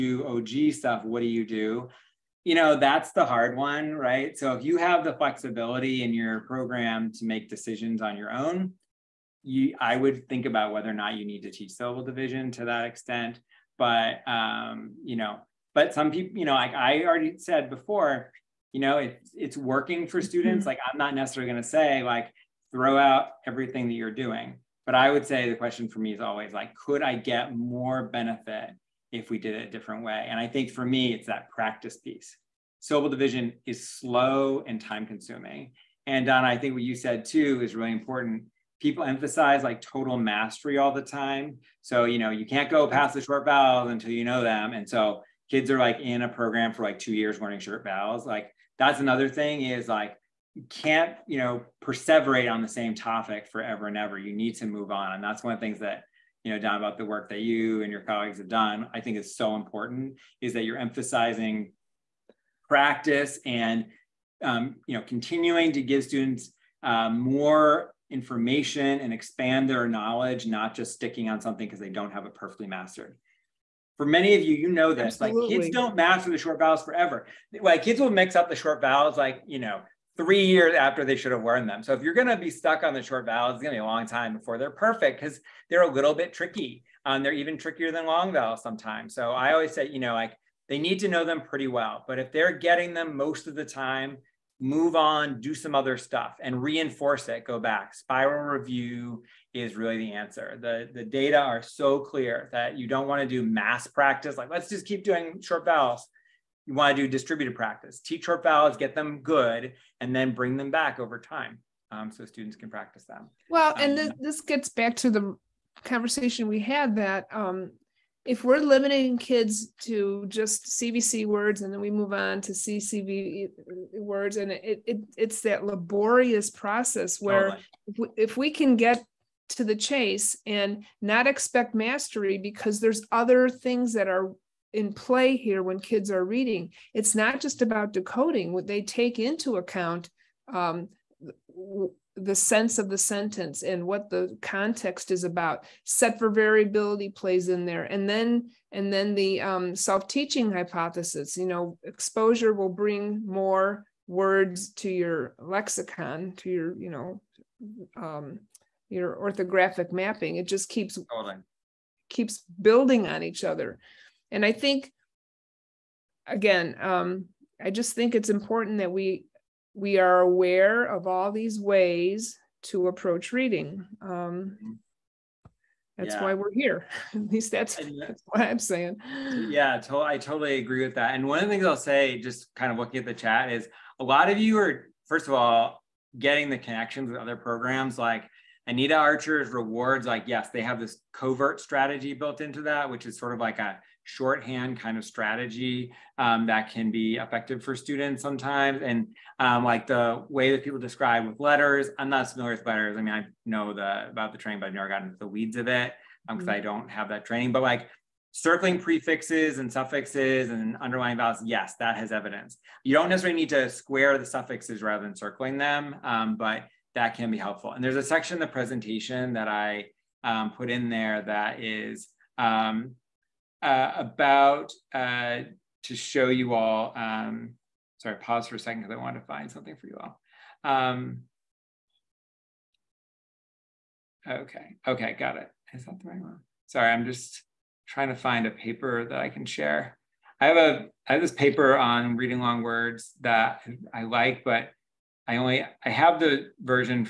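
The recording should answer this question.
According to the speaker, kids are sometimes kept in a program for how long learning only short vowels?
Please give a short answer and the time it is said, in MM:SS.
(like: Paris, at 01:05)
two years, at 00:46.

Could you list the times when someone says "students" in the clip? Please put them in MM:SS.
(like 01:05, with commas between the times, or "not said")
00:20, 01:06, 01:52, 03:17.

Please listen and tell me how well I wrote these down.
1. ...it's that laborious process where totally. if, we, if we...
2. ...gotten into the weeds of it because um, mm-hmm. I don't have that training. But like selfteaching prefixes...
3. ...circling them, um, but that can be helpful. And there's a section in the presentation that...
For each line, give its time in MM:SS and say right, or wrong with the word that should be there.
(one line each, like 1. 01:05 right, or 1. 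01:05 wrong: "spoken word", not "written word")
1. 02:05 right
2. 03:24 wrong: "circling", not "selfteaching"
3. 03:35 right.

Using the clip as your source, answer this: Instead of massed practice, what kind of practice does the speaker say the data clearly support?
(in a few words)
distributed practice.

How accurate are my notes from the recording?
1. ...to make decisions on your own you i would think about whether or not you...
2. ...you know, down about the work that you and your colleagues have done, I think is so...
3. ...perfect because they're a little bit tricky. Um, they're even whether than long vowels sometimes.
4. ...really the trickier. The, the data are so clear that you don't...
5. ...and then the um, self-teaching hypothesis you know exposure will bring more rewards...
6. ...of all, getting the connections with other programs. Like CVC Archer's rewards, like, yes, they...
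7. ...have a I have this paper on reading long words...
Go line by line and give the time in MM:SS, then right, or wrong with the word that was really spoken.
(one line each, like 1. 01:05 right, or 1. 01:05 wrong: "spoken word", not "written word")
1. 00:07 right
2. 00:56 right
3. 01:24 wrong: "trickier", not "whether"
4. 01:39 wrong: "answer", not "trickier"
5. 02:28 wrong: "words", not "rewards"
6. 03:05 wrong: "Anita", not "CVC"
7. 04:00 right.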